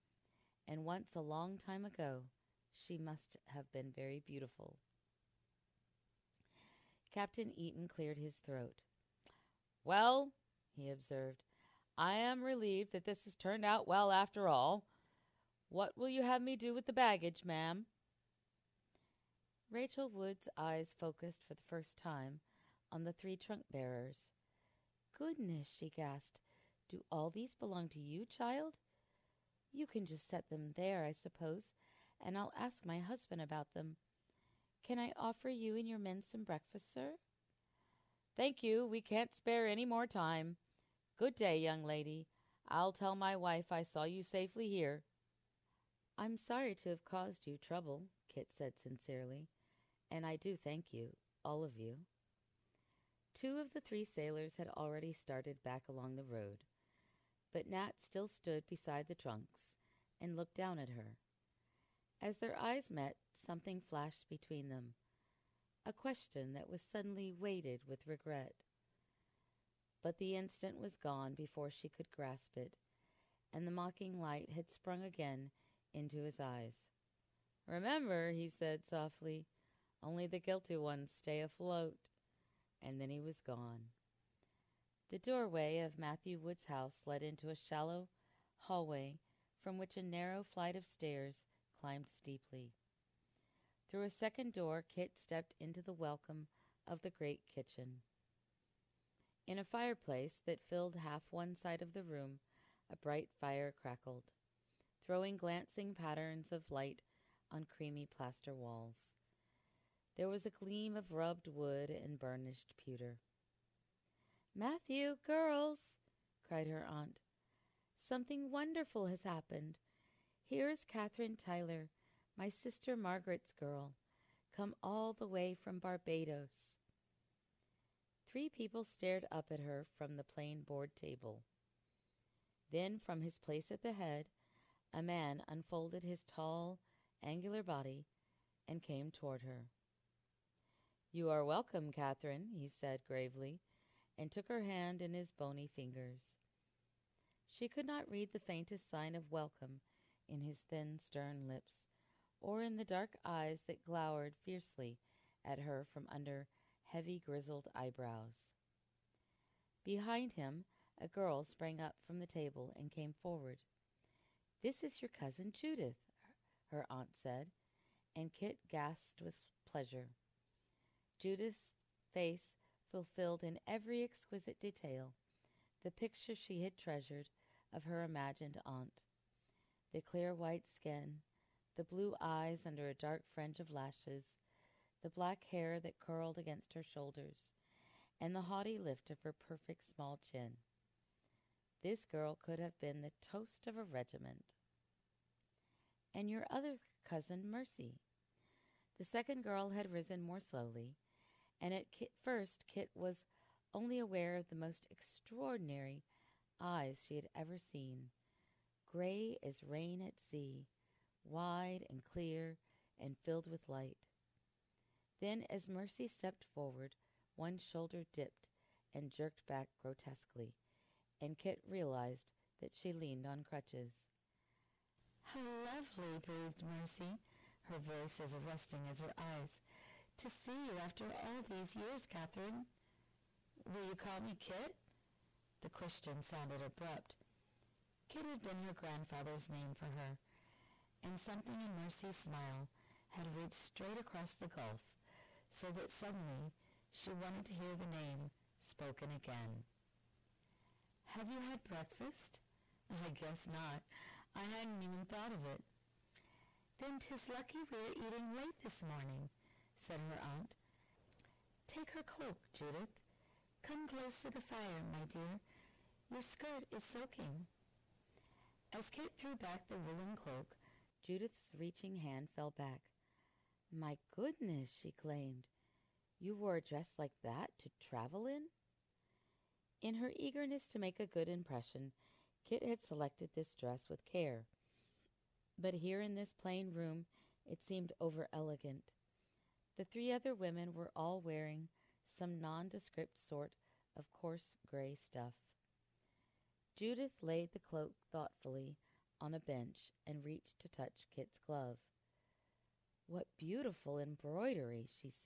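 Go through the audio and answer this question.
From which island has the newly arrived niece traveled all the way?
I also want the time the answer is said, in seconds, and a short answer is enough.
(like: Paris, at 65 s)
Barbados, at 125 s.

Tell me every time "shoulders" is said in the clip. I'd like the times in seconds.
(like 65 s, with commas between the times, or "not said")
186 s, 217 s.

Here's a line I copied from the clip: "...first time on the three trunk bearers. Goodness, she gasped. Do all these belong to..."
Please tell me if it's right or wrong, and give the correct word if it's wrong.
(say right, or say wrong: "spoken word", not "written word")
right.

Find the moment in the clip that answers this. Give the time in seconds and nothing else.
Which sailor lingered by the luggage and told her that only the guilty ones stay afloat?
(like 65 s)
57 s.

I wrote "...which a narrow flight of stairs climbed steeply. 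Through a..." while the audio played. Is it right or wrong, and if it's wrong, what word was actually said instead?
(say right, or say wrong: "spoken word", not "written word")
right.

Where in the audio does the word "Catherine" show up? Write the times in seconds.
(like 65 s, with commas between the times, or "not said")
120 s, 141 s, 232 s.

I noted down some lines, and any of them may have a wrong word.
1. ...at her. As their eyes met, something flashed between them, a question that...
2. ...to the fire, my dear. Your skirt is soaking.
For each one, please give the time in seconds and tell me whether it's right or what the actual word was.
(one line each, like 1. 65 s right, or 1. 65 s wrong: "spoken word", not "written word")
1. 60 s right
2. 264 s right.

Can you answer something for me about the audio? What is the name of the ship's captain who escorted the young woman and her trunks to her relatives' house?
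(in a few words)
Captain Eaton.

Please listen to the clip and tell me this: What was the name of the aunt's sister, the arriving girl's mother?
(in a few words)
Margaret.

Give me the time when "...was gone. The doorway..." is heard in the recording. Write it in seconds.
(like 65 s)
83 s.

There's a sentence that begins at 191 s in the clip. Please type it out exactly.
This girl could have been the toast of a regiment.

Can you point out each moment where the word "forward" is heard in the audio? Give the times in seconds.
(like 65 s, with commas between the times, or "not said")
163 s, 216 s.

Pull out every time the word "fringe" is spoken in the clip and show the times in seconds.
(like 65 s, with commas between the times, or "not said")
183 s.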